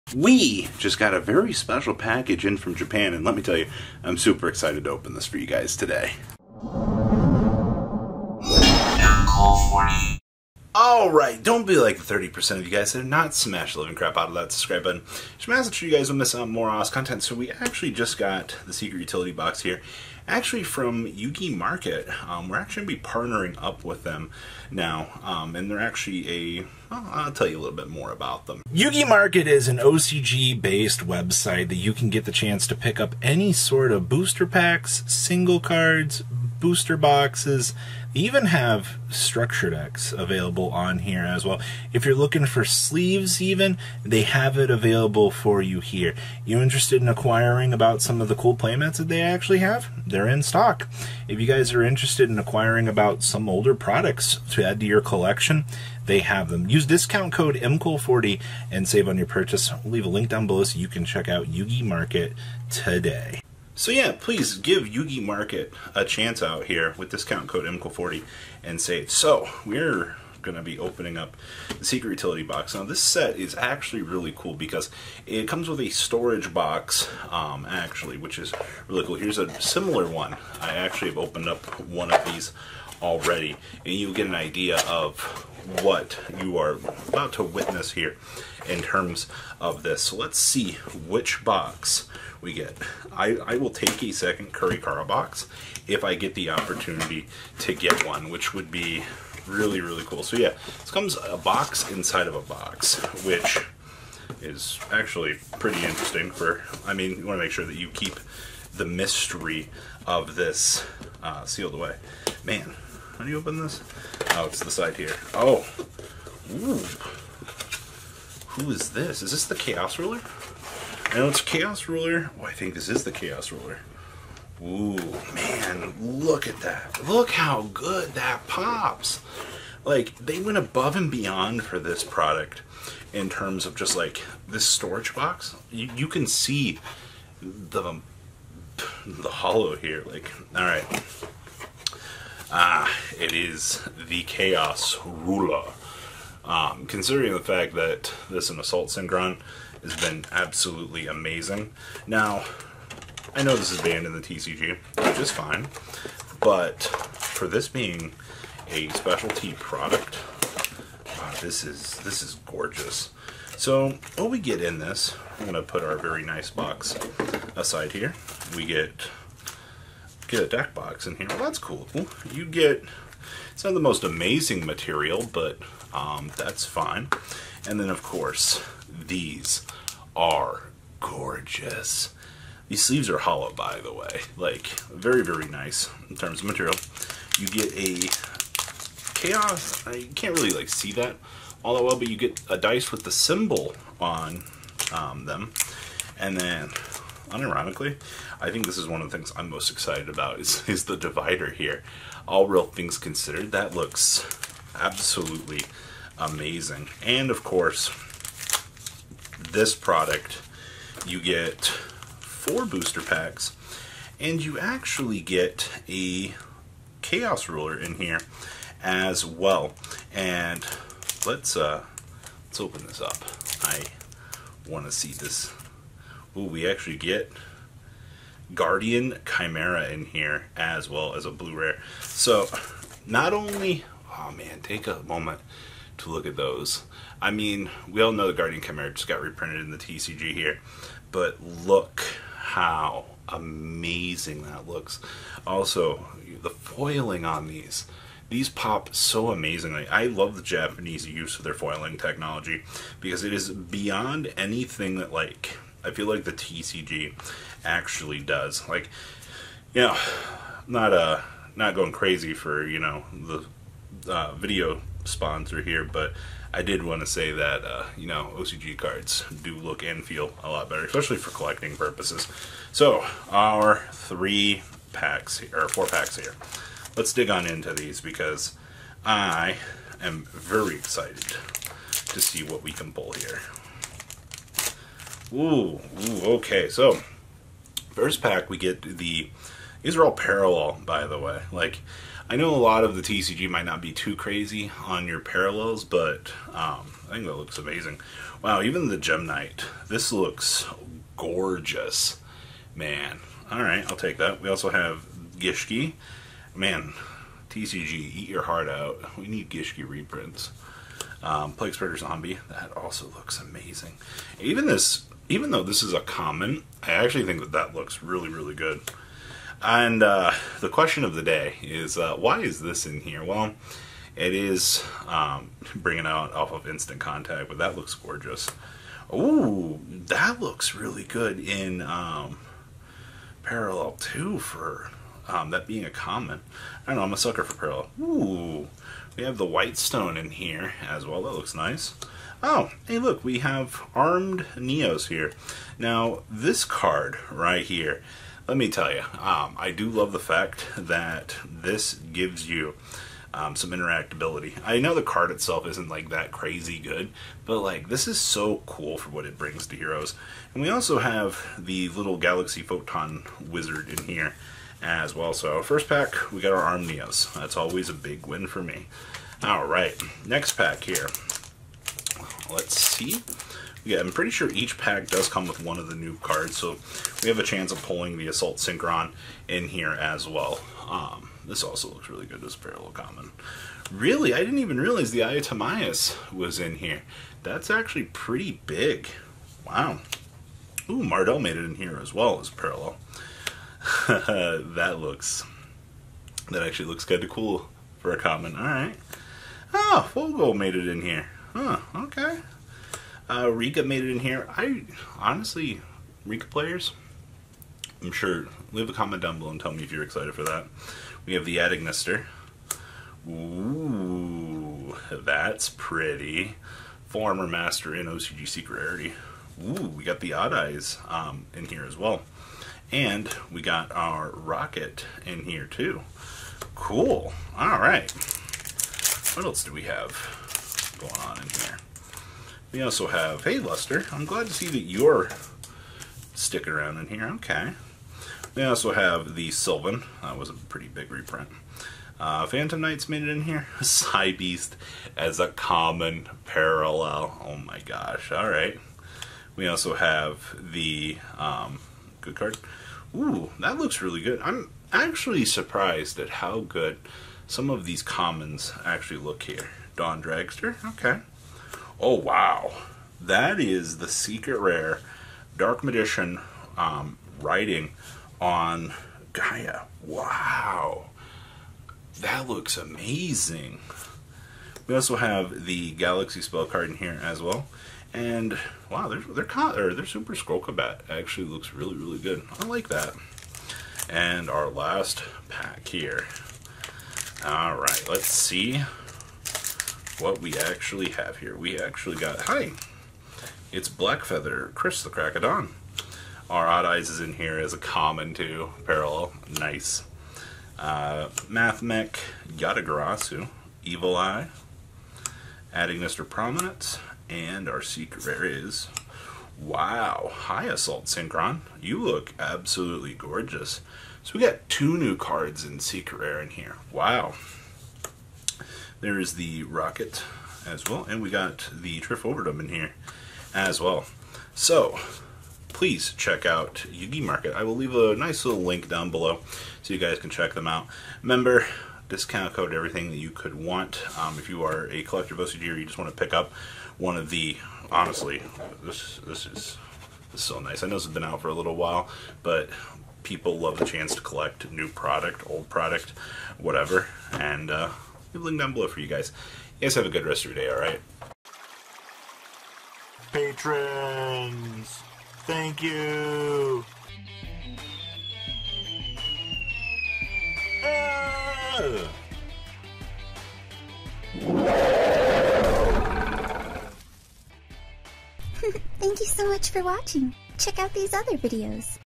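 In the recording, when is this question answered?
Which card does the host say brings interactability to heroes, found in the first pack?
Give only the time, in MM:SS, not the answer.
05:43.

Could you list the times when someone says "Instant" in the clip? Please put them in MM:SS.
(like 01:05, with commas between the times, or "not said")
05:26.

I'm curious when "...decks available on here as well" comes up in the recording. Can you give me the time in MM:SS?
00:39.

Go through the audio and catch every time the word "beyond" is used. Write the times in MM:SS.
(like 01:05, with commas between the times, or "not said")
02:11, 04:13.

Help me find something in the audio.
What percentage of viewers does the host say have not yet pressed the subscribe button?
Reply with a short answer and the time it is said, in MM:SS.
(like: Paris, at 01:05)
30%, at 00:12.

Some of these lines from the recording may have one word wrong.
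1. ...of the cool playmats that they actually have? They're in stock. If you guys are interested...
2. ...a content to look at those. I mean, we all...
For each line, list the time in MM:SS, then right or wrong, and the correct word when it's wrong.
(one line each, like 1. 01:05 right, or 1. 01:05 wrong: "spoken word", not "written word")
1. 00:48 right
2. 03:54 wrong: "moment", not "content".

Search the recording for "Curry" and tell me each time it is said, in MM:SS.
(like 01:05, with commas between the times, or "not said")
01:34.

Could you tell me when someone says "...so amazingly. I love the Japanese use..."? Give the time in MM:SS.
04:08.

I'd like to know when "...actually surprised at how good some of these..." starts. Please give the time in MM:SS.
07:34.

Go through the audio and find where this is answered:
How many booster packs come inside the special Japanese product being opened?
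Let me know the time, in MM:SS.
03:31.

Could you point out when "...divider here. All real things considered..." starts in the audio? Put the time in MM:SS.
03:20.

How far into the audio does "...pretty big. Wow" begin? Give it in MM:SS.
06:28.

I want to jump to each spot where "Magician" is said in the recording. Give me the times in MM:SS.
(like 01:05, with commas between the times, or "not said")
07:45.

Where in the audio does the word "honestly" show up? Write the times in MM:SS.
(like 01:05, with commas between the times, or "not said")
06:45, 08:57.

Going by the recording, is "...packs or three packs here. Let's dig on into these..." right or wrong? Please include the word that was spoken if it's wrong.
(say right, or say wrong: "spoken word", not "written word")
wrong: "four", not "three".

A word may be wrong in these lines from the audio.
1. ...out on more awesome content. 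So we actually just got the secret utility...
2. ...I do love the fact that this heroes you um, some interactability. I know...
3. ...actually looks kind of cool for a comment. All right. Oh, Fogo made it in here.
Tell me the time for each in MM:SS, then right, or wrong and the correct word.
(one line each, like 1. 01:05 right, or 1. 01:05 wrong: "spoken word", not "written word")
1. 00:16 right
2. 05:49 wrong: "gives", not "heroes"
3. 06:36 right.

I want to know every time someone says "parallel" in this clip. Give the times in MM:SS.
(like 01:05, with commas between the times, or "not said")
04:50, 04:55, 05:33, 05:37, 06:22, 06:32, 07:26, 08:18.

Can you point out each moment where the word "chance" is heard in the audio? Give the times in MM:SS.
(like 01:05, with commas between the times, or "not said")
00:32, 01:06, 06:17, 09:03.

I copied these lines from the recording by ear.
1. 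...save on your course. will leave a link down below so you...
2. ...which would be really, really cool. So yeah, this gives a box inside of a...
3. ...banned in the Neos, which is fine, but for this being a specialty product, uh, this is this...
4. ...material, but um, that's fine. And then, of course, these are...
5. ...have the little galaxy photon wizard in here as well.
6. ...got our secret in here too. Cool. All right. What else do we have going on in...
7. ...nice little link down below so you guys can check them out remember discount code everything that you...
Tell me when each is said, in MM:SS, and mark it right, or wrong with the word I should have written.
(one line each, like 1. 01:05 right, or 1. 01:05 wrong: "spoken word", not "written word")
1. 00:58 wrong: "purchase", not "course"
2. 01:38 wrong: "comes", not "gives"
3. 02:33 wrong: "TCG", not "Neos"
4. 02:54 right
5. 06:00 right
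6. 07:03 wrong: "rocket", not "secret"
7. 08:48 right.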